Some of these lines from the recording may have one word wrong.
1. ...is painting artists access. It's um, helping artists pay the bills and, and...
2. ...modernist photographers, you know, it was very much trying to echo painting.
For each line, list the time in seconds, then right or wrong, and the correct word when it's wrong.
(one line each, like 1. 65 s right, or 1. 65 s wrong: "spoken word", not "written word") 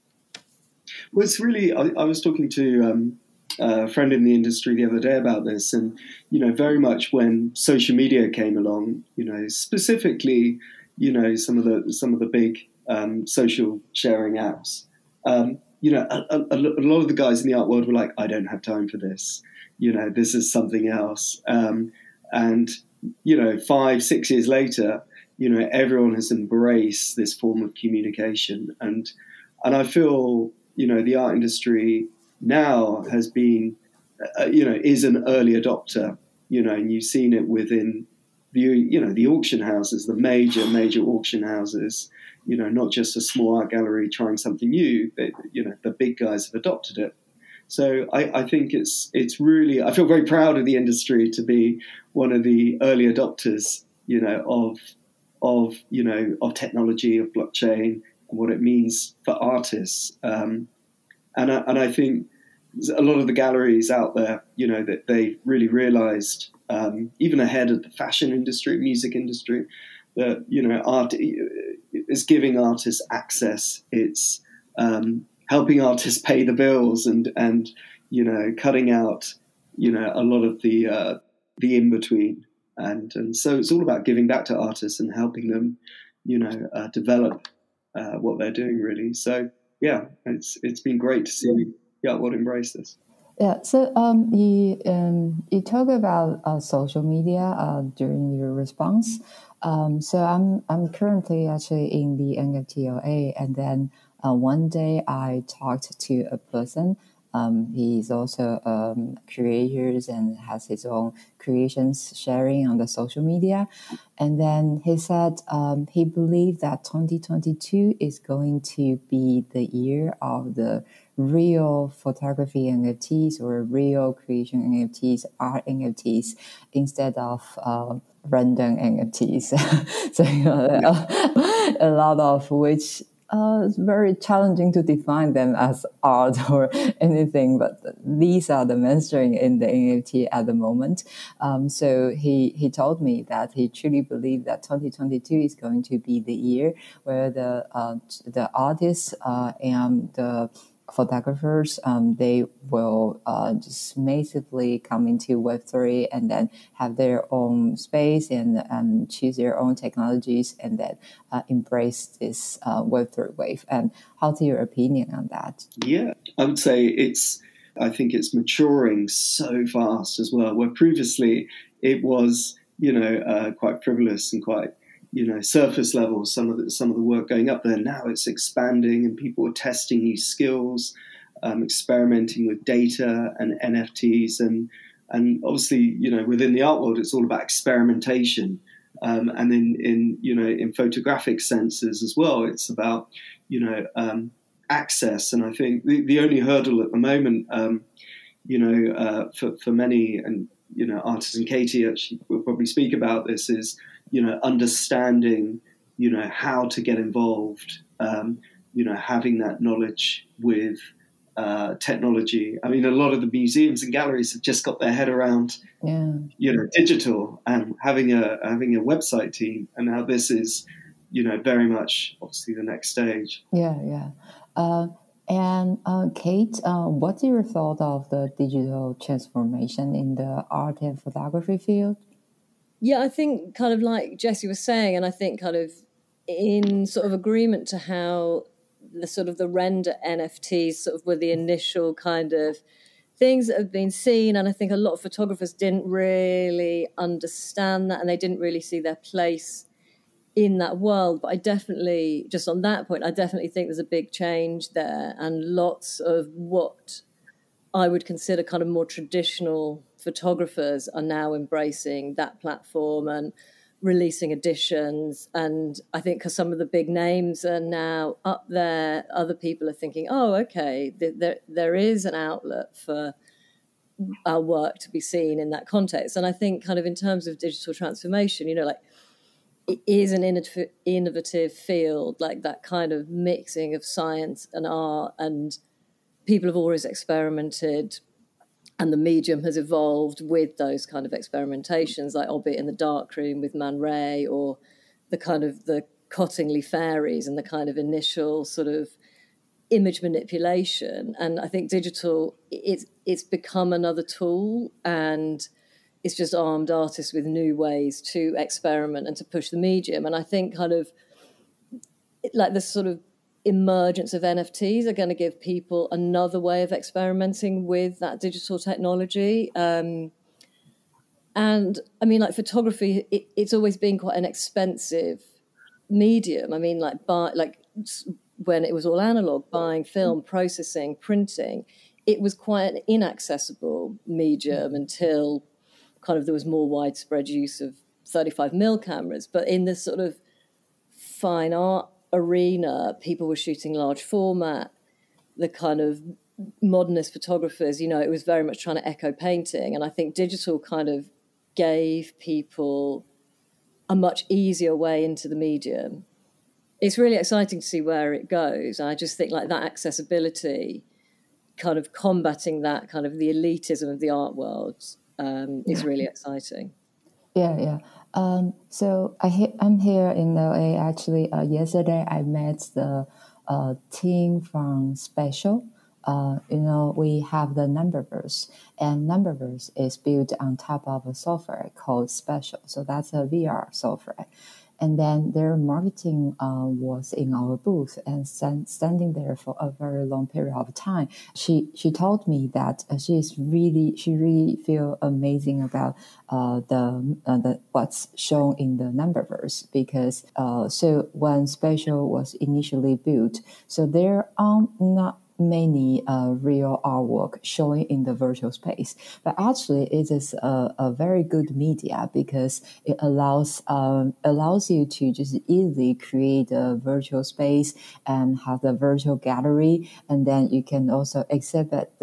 1. 71 s wrong: "giving", not "painting"
2. 346 s right.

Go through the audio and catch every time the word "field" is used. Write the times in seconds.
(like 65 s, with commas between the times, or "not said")
231 s, 281 s.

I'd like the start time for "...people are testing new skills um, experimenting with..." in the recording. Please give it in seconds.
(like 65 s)
179 s.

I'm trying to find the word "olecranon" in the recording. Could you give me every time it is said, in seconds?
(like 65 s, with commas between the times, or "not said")
not said.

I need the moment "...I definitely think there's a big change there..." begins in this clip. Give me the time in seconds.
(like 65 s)
253 s.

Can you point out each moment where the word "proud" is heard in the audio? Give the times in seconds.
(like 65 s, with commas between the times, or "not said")
50 s.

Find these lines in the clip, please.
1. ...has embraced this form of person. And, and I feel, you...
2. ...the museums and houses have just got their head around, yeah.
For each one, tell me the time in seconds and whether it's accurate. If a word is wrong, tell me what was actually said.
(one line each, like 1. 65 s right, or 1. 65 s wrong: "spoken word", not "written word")
1. 26 s wrong: "communication", not "person"
2. 213 s wrong: "galleries", not "houses".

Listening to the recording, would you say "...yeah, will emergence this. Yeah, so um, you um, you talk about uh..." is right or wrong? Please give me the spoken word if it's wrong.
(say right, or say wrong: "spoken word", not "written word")
wrong: "embrace", not "emergence".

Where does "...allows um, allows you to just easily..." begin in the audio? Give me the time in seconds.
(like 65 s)
412 s.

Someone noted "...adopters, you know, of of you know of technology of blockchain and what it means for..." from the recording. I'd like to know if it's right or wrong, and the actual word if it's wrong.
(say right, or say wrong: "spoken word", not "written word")
right.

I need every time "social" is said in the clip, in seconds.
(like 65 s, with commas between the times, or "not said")
7 s, 13 s, 96 s, 112 s.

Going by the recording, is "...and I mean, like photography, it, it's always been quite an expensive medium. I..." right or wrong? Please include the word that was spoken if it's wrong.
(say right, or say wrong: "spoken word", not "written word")
right.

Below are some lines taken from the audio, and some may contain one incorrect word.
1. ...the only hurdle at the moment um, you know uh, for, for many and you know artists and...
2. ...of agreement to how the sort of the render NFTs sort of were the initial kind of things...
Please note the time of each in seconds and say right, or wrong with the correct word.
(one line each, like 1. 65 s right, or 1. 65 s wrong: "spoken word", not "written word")
1. 196 s right
2. 237 s right.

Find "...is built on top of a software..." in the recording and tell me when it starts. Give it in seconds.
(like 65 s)
379 s.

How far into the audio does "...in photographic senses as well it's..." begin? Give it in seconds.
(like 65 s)
190 s.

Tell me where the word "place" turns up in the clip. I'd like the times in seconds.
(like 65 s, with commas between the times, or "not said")
248 s.